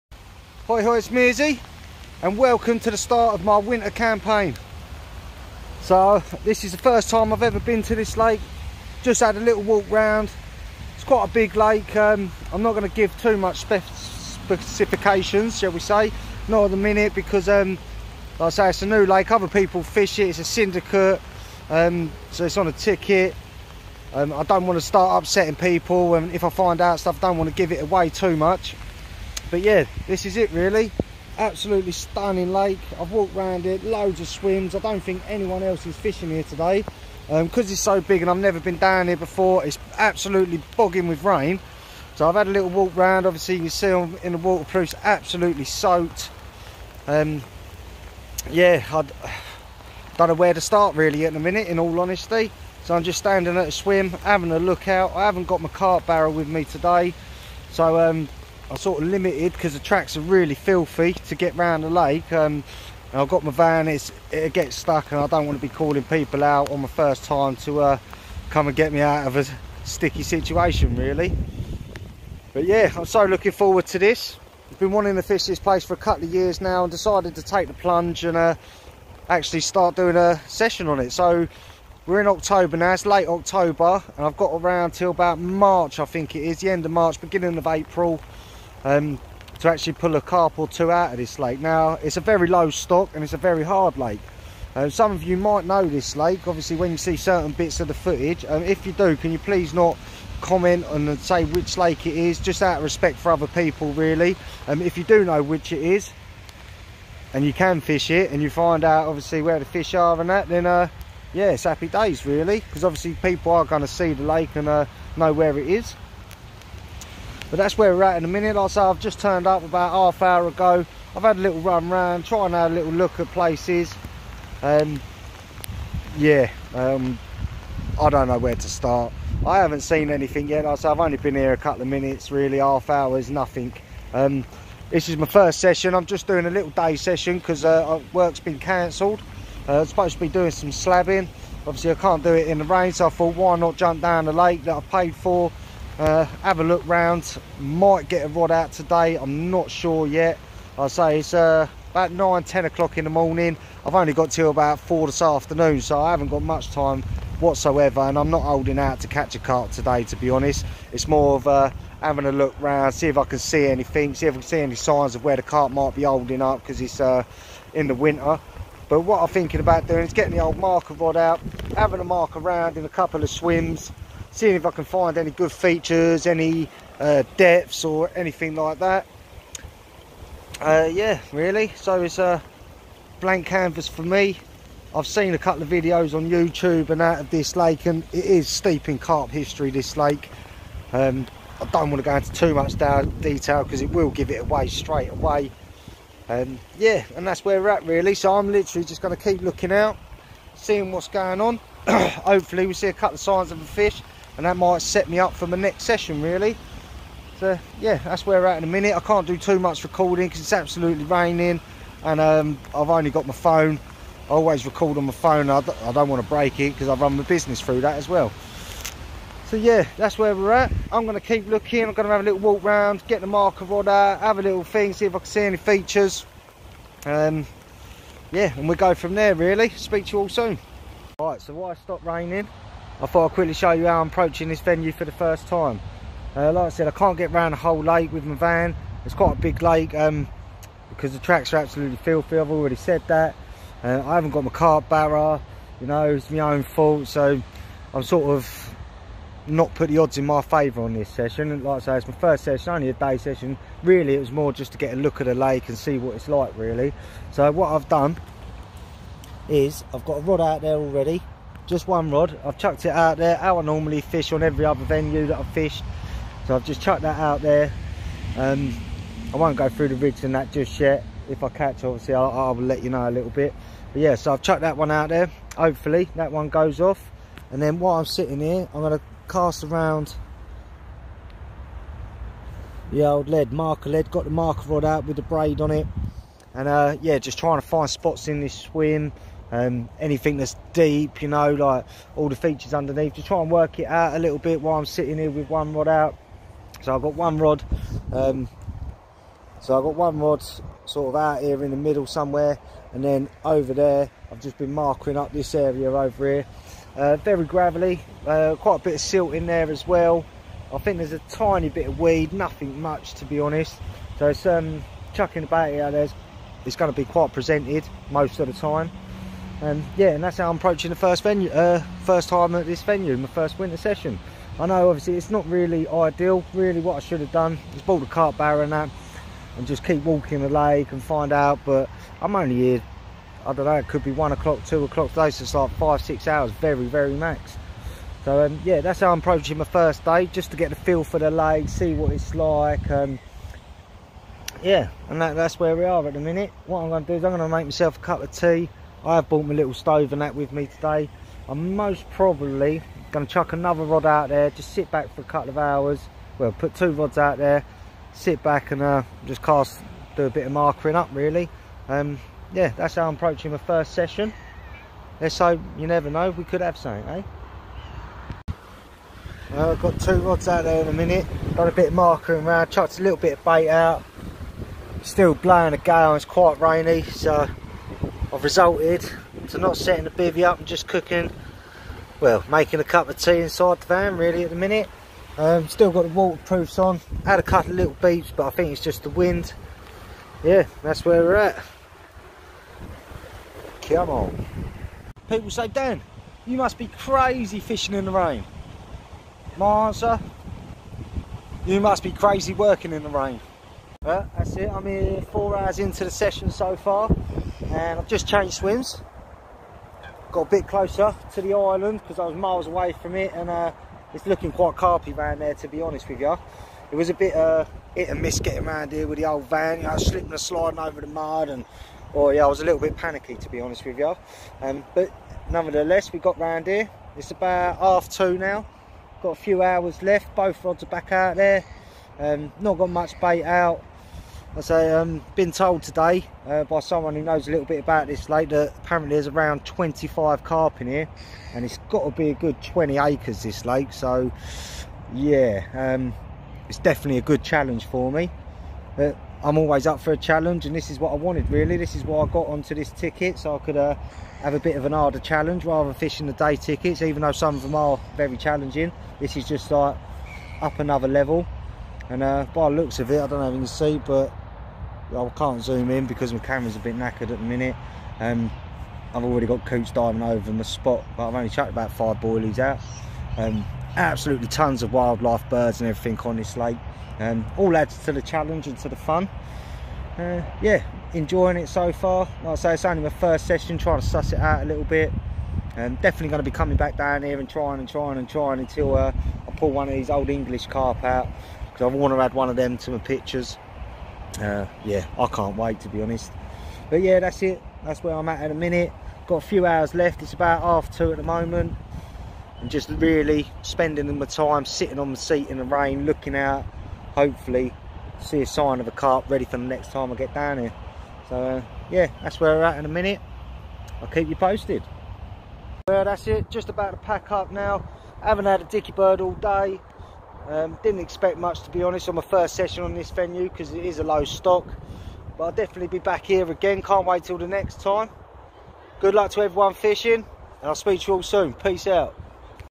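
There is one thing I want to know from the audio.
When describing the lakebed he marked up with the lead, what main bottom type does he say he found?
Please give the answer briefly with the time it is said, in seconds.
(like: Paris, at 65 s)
Gravelly, at 307 s.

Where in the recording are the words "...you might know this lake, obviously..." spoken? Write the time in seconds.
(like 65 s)
95 s.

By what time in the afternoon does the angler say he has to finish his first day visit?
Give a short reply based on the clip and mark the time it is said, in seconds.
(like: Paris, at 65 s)
4, at 154 s.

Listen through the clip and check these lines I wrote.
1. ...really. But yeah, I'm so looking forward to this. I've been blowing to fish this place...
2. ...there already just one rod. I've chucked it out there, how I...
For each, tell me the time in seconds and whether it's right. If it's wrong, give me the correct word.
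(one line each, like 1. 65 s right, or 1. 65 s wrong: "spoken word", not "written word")
1. 70 s wrong: "wanting", not "blowing"
2. 260 s right.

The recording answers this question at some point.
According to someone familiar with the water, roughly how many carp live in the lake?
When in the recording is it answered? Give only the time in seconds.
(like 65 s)
439 s.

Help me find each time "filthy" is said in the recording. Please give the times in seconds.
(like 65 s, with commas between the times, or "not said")
60 s, 241 s.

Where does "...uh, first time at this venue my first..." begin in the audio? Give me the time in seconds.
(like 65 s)
321 s.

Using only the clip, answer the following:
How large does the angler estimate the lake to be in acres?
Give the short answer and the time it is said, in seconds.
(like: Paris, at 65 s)
20 acres, at 442 s.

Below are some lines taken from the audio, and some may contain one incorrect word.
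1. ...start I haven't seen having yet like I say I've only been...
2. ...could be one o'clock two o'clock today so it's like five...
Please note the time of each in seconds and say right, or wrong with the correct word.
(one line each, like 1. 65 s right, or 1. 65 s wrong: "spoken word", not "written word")
1. 128 s wrong: "anything", not "having"
2. 333 s right.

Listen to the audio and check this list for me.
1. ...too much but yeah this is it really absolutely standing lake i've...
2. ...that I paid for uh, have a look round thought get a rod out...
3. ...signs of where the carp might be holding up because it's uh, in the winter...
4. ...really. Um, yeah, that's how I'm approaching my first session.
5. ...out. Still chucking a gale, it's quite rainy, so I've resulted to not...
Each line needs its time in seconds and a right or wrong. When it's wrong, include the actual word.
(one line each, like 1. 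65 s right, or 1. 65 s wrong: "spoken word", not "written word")
1. 28 s wrong: "stunning", not "standing"
2. 144 s wrong: "might", not "thought"
3. 164 s right
4. 361 s right
5. 373 s wrong: "blowing", not "chucking".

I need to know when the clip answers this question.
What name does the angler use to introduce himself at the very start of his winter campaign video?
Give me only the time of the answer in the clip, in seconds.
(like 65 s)
1 s.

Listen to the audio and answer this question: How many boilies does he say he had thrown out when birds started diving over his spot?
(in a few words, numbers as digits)
5.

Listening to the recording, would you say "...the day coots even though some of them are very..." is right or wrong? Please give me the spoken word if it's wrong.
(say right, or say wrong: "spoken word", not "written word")
wrong: "tickets", not "coots".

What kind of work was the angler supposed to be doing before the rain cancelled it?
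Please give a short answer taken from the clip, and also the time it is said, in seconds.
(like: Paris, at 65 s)
Slabbing, at 140 s.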